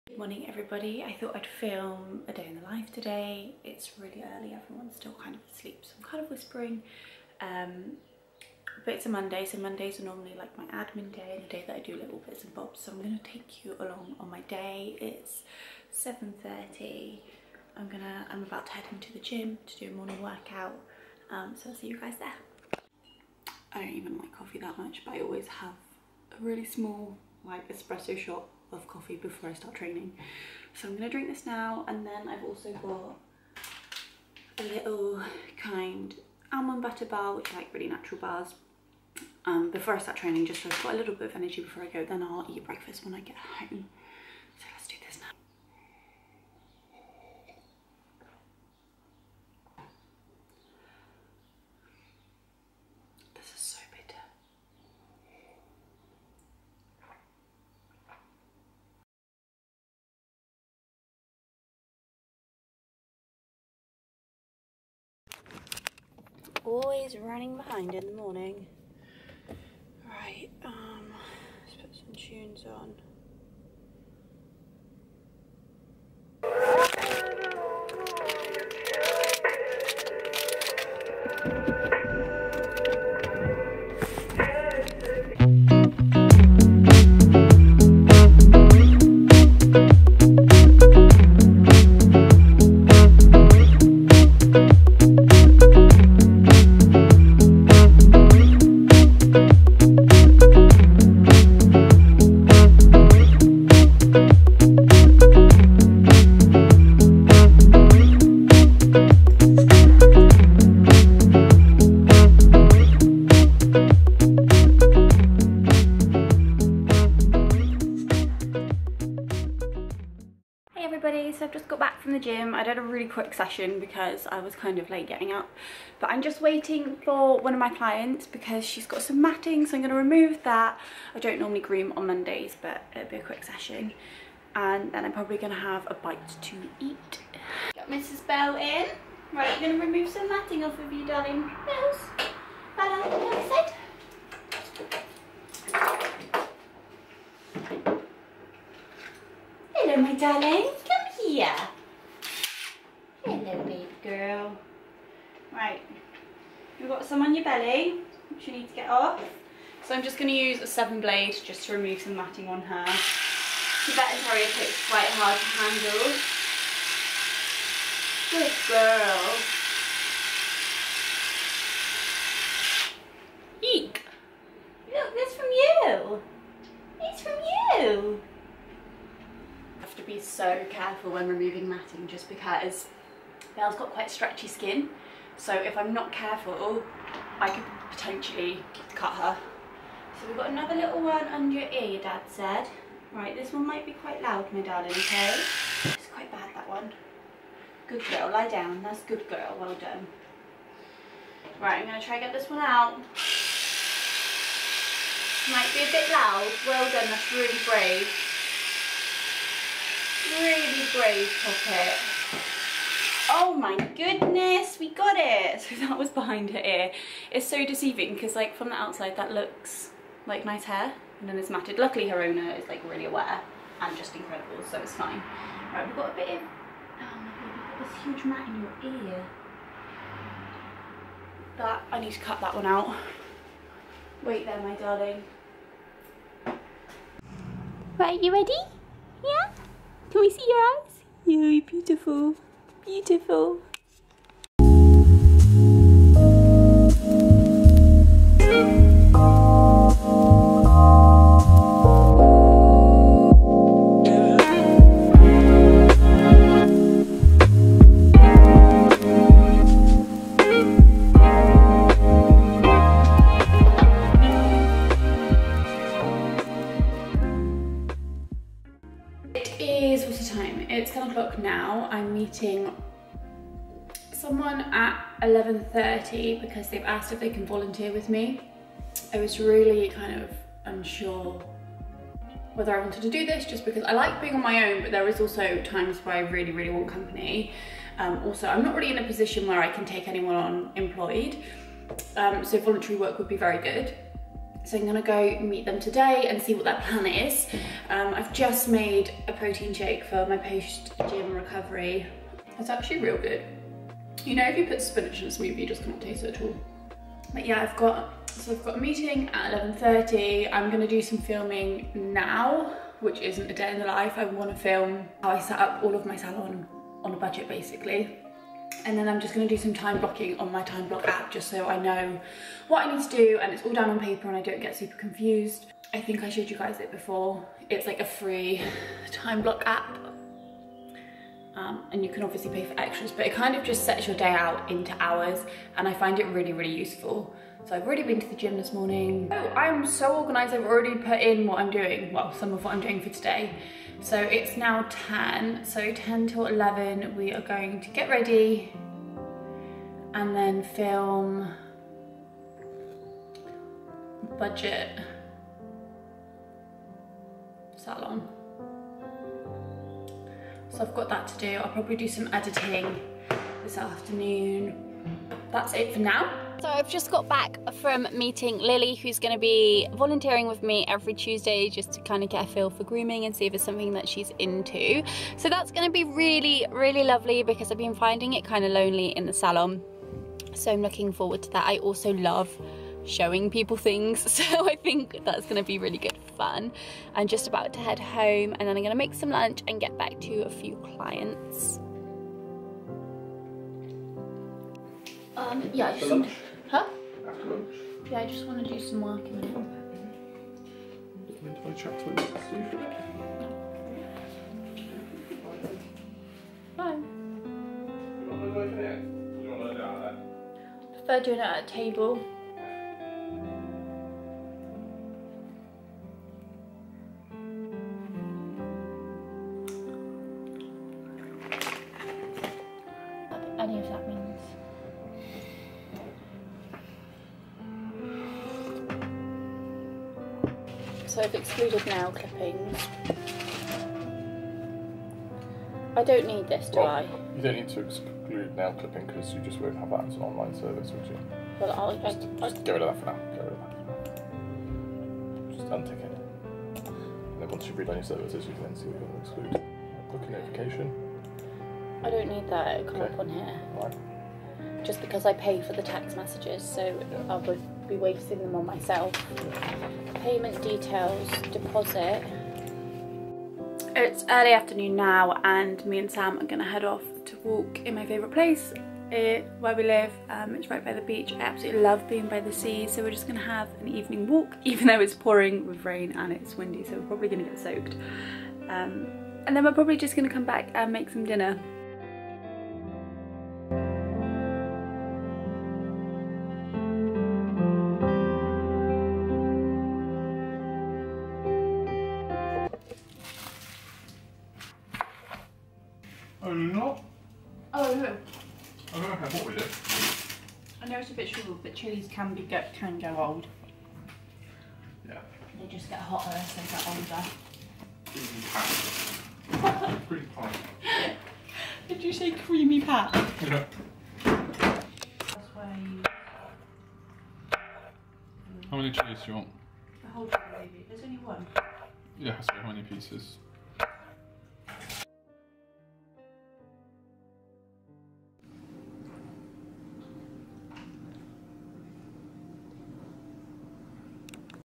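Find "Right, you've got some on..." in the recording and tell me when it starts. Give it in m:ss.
2:35.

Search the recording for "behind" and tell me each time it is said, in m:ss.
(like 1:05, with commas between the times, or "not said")
1:07, 3:36.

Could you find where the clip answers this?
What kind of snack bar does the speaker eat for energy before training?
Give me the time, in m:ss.
0:36.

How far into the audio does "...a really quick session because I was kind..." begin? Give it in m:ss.
2:02.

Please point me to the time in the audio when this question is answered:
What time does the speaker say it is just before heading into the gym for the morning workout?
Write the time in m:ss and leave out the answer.
0:15.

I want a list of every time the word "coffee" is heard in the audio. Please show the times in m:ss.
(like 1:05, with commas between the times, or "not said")
0:24, 0:28.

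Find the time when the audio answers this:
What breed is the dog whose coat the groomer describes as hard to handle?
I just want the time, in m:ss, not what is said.
2:43.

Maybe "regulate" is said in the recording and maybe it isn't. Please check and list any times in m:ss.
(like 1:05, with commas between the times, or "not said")
not said.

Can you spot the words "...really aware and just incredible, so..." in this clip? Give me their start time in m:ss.
3:42.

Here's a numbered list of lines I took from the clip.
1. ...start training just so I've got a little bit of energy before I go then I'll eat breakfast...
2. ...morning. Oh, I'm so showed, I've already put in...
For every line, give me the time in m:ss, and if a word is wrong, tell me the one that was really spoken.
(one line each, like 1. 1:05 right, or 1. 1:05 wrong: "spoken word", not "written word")
1. 0:39 right
2. 5:38 wrong: "organized", not "showed".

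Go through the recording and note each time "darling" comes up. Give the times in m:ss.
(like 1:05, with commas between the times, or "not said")
2:21, 2:30, 3:14, 3:54.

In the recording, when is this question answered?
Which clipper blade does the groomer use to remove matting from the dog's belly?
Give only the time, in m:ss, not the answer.
2:40.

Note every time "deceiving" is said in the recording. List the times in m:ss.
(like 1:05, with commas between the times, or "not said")
3:37.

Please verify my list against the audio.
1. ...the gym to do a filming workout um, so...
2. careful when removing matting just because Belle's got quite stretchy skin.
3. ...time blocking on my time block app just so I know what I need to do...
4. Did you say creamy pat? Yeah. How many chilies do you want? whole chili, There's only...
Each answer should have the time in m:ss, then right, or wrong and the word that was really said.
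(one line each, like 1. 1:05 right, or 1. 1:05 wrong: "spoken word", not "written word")
1. 0:19 wrong: "morning", not "filming"
2. 3:01 right
3. 5:19 right
4. 8:31 right.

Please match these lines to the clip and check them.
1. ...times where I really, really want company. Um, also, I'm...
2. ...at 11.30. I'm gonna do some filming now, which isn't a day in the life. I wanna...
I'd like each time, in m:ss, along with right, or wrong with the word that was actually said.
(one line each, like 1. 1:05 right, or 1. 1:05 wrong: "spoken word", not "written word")
1. 4:45 right
2. 5:09 right.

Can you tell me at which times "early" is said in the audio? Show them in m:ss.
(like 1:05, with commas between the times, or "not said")
0:04, 7:44.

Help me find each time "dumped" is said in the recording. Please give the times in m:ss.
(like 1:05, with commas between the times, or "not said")
not said.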